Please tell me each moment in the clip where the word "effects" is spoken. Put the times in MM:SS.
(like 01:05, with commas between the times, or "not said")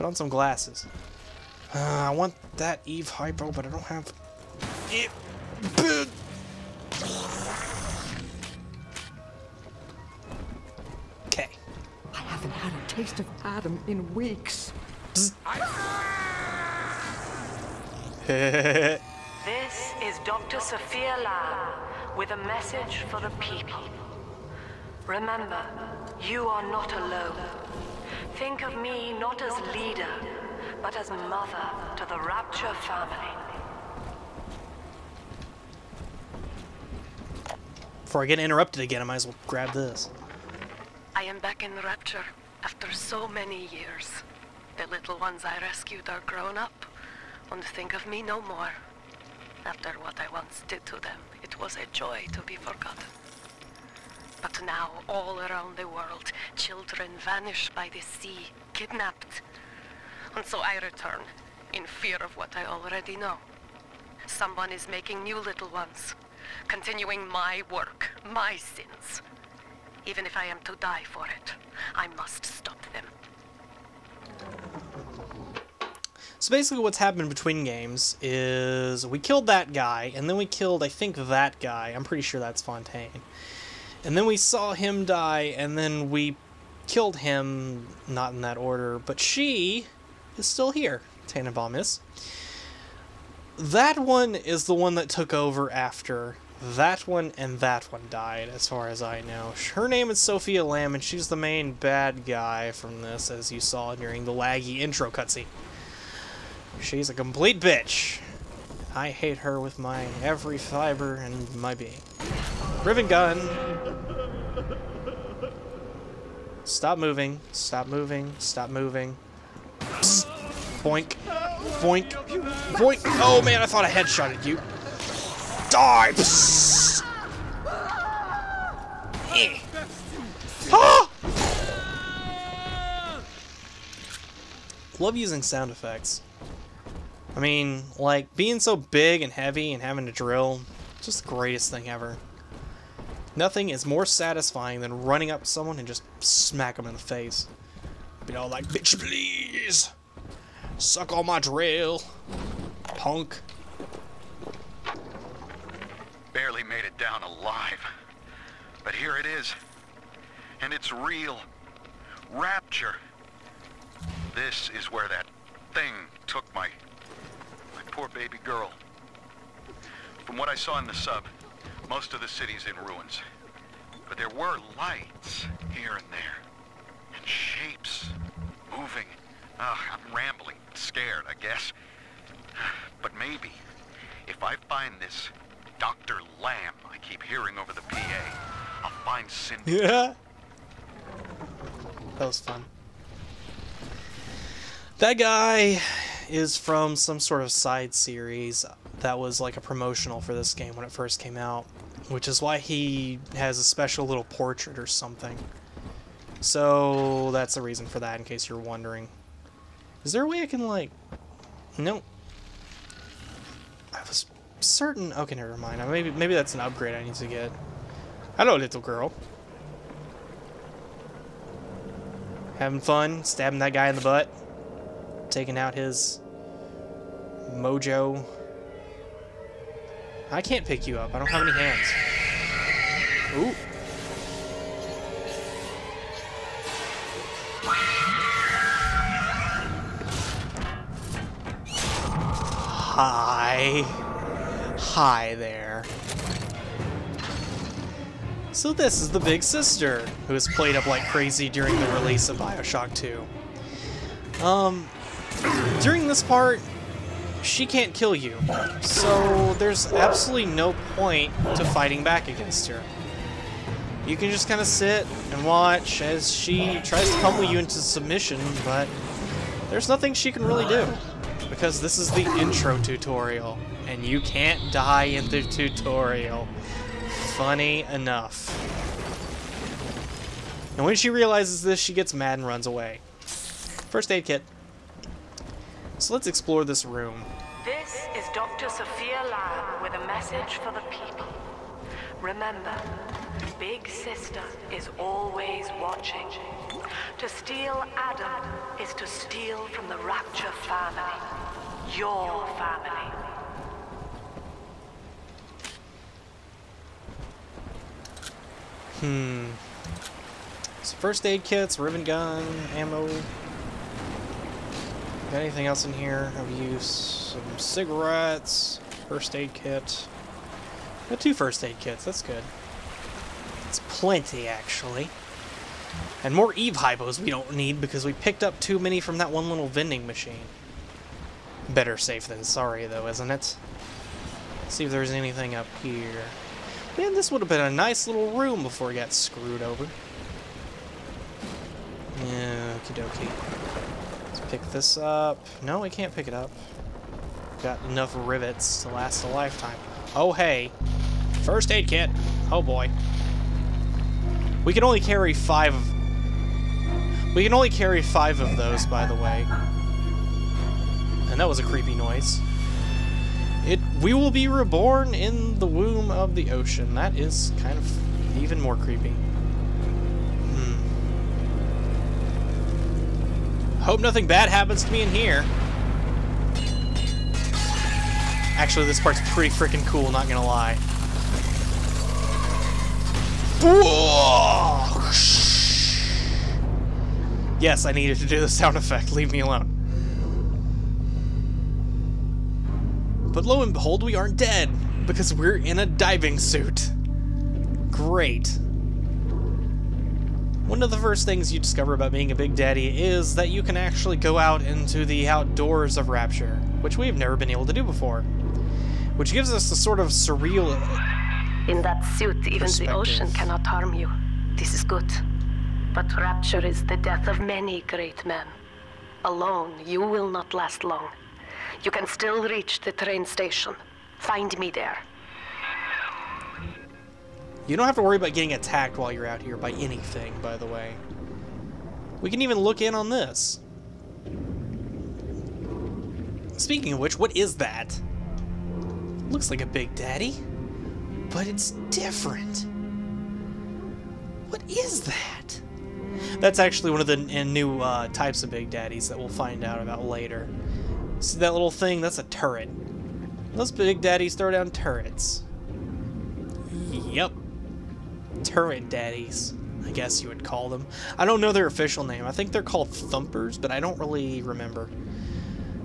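02:15, 06:28.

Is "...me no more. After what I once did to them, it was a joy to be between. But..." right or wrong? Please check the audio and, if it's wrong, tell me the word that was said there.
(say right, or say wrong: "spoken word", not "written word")
wrong: "forgotten", not "between".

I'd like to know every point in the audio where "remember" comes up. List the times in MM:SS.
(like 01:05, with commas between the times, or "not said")
00:25, 04:52, 07:44.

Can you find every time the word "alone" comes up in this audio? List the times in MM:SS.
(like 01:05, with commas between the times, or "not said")
00:26, 06:29, 06:59.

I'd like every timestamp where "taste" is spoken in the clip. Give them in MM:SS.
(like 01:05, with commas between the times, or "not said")
00:12.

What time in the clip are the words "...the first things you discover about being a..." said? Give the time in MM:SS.
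06:40.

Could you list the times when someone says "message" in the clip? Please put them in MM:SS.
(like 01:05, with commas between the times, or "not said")
00:22, 04:50.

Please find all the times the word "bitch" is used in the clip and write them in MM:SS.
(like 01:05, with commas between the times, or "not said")
01:47, 02:28.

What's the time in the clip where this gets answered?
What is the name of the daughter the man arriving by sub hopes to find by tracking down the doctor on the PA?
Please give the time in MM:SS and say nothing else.
03:09.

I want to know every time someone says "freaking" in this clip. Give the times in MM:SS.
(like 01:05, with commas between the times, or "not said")
06:19.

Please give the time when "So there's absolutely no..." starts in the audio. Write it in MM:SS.
04:18.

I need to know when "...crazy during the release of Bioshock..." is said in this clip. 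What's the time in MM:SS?
04:11.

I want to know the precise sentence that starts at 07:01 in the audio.
You can still reach the train station.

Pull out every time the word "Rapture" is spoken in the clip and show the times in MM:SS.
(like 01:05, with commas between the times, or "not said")
00:32, 00:41, 02:42, 04:59, 06:46, 06:56.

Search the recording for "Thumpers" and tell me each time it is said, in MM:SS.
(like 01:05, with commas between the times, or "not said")
07:42.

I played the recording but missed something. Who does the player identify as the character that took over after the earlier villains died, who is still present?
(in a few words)
Tenenbaum.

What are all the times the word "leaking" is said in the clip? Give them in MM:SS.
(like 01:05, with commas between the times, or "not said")
not said.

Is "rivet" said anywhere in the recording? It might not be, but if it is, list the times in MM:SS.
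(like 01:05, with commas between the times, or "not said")
01:52, 05:11, 05:48.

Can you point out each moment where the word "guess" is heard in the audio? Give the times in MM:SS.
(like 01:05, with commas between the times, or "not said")
03:01, 07:39.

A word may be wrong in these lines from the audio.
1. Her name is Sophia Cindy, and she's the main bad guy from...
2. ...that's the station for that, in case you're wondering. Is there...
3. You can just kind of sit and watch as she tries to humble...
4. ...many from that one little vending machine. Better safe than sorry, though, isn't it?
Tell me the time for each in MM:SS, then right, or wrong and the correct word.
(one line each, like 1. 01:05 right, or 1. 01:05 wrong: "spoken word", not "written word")
1. 01:39 wrong: "Lamb", not "Cindy"
2. 03:27 wrong: "reason", not "station"
3. 04:24 right
4. 05:28 right.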